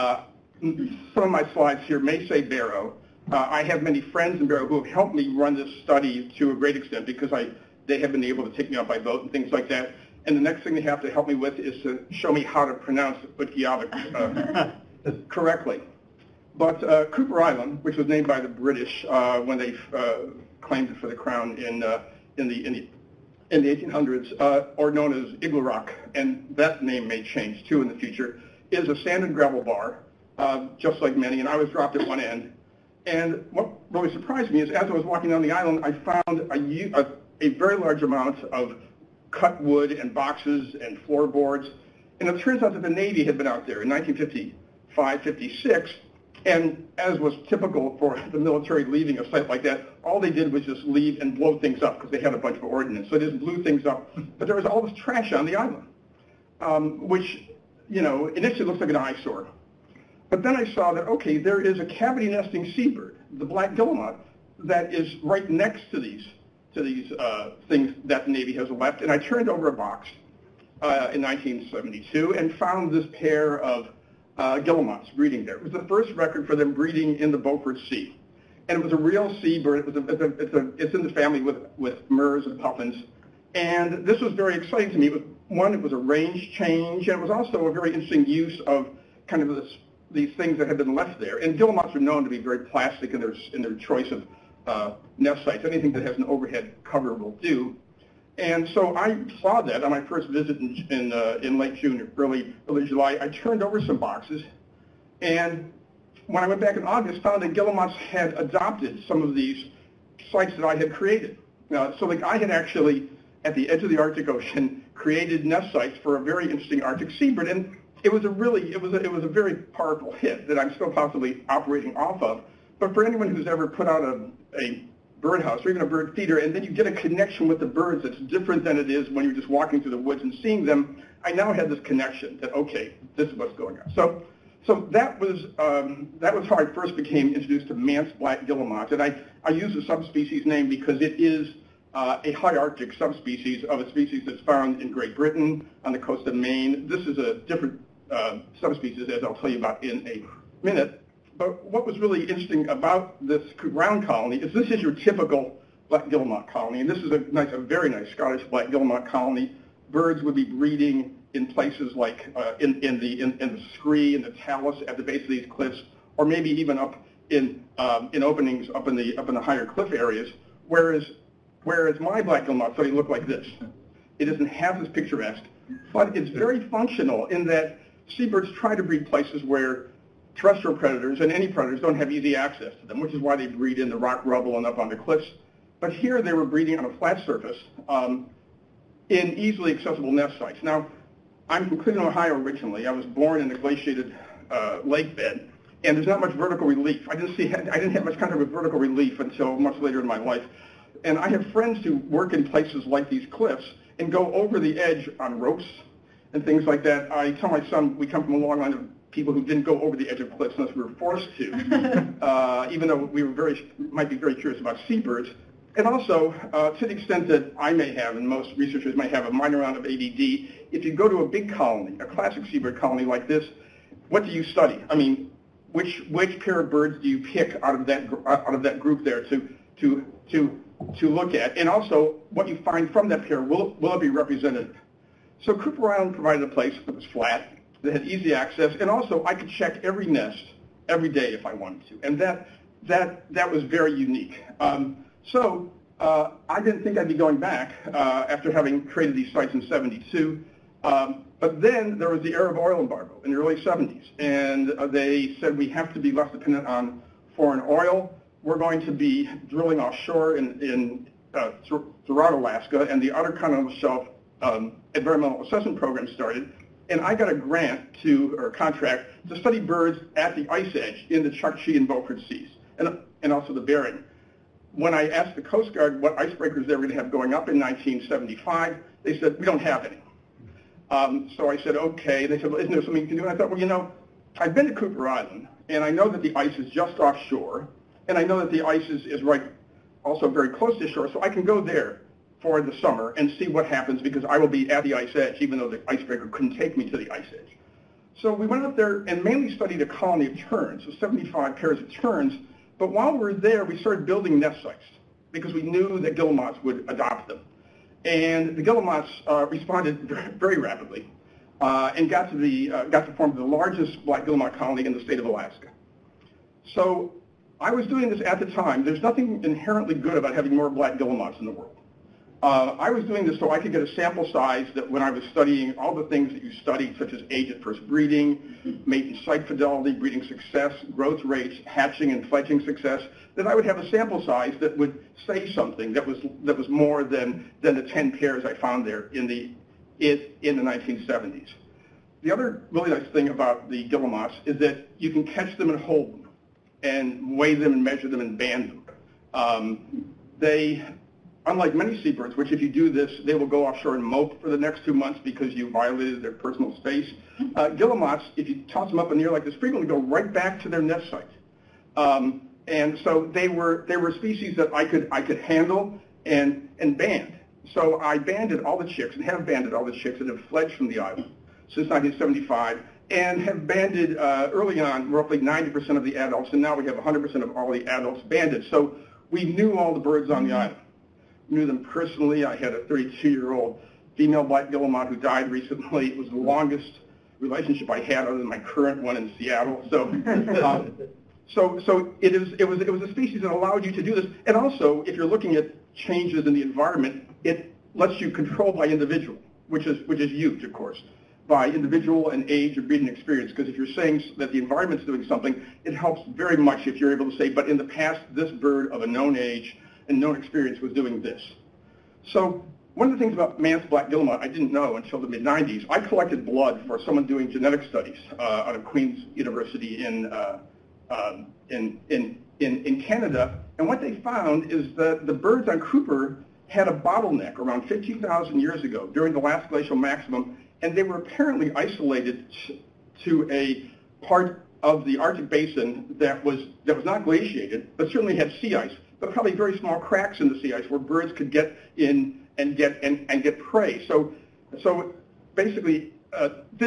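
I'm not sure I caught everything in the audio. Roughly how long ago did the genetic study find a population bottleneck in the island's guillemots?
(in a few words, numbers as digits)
15,000 years ago.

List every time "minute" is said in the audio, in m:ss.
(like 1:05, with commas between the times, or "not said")
2:30.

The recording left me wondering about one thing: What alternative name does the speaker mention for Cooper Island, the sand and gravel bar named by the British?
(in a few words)
Igloo Rock.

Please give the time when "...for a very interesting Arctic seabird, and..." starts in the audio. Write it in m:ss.
1:56.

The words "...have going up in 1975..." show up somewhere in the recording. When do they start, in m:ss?
4:36.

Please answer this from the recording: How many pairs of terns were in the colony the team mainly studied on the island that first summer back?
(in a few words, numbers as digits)
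75.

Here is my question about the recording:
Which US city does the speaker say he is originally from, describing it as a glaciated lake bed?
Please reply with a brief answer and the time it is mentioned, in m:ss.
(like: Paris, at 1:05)
Cleveland, Ohio, at 3:11.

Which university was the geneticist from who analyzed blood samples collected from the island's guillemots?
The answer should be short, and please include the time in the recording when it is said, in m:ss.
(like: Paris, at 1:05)
Queen's University, at 6:58.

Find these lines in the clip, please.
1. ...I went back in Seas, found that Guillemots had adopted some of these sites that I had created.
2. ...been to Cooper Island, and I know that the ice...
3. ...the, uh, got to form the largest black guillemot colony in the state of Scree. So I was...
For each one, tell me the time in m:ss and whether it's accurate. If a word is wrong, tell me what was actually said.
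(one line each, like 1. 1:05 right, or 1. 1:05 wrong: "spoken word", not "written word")
1. 1:46 wrong: "August", not "Seas"
2. 4:44 right
3. 5:12 wrong: "Alaska", not "Scree".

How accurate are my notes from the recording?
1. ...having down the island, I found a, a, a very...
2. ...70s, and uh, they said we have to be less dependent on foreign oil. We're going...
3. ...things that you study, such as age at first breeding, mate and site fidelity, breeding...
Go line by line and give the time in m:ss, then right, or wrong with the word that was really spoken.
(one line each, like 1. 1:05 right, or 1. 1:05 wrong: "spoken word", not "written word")
1. 0:35 wrong: "walking", not "having"
2. 4:13 right
3. 5:26 right.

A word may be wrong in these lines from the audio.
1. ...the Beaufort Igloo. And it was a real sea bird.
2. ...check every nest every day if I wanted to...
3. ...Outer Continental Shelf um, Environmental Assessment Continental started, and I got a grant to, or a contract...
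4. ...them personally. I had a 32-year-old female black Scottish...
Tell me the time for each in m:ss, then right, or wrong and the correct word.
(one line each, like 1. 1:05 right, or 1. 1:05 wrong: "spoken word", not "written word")
1. 1:17 wrong: "Sea", not "Igloo"
2. 3:59 right
3. 4:23 wrong: "Program", not "Continental"
4. 6:21 wrong: "Guillemot", not "Scottish".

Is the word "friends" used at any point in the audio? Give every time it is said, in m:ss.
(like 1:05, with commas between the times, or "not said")
0:04, 3:21.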